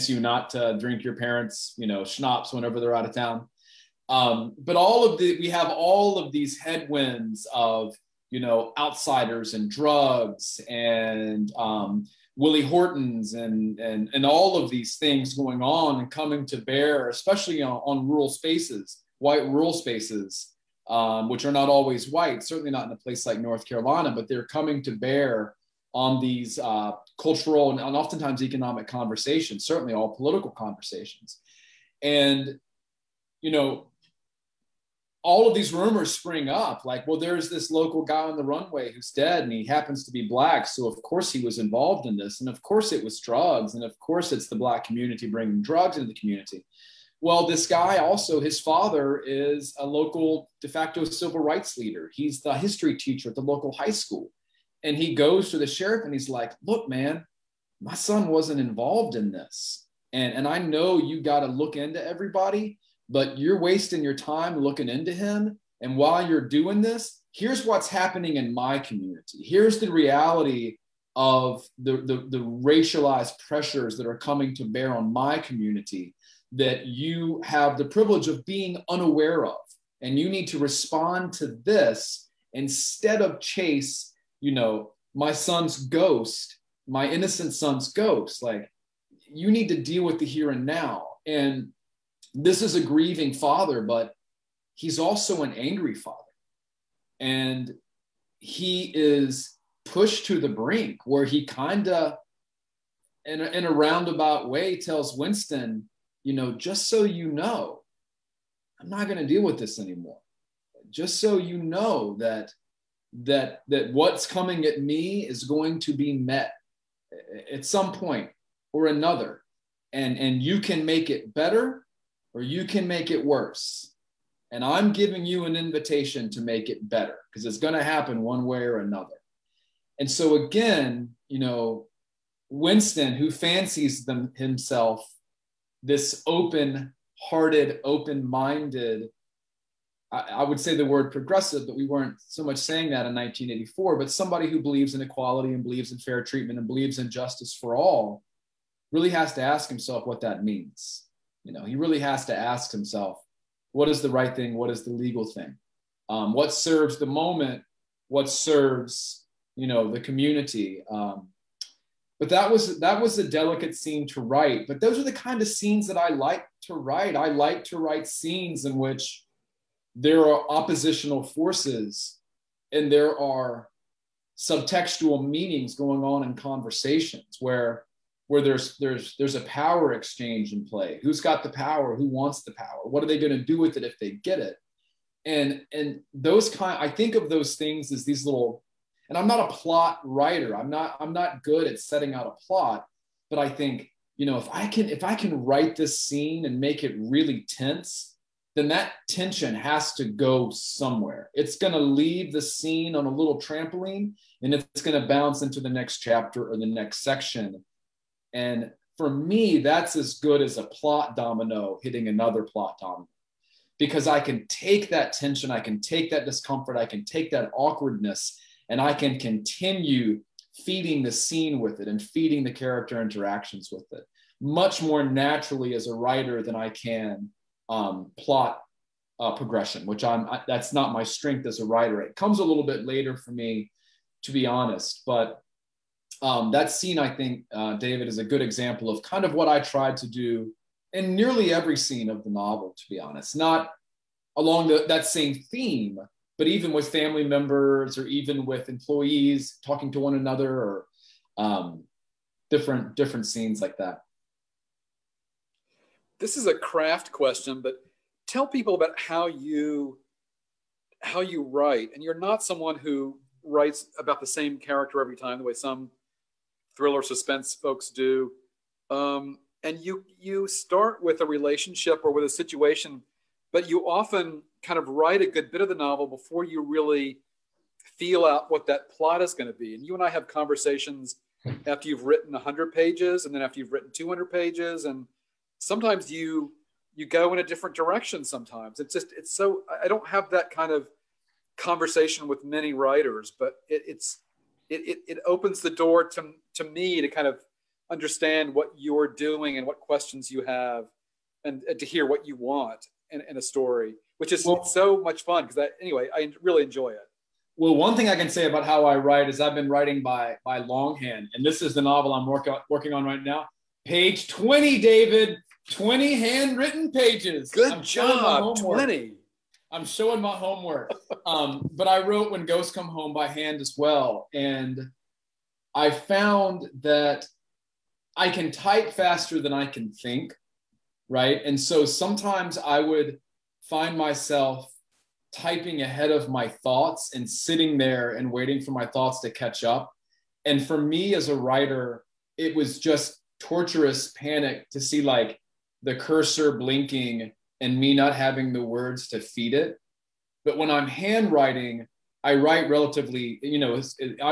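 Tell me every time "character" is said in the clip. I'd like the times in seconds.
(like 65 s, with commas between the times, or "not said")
222 s, 264 s.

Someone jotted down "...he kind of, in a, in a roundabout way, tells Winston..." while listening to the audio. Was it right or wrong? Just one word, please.
right.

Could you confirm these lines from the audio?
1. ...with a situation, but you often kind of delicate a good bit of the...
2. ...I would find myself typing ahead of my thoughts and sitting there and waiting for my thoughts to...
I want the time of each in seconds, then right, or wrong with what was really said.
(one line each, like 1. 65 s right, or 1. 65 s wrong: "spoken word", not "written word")
1. 272 s wrong: "write", not "delicate"
2. 332 s right.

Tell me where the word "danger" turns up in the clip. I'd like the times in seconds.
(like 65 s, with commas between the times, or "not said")
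not said.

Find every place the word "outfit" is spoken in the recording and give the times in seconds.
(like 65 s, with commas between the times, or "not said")
not said.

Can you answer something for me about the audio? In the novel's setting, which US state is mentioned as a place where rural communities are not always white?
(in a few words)
North Carolina.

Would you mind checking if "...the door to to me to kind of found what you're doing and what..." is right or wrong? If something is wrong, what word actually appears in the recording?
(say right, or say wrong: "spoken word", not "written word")
wrong: "understand", not "found".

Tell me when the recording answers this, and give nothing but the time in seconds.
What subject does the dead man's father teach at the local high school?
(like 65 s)
52 s.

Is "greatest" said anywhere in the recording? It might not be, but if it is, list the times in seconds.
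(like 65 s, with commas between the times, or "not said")
not said.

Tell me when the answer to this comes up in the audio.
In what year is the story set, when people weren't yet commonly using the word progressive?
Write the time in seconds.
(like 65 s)
143 s.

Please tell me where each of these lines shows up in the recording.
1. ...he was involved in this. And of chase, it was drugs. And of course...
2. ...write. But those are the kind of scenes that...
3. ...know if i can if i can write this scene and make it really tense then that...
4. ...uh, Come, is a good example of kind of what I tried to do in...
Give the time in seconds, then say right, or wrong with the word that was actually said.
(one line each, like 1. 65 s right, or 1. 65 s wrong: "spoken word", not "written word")
1. 41 s wrong: "course", not "chase"
2. 164 s right
3. 194 s right
4. 237 s wrong: "David", not "Come".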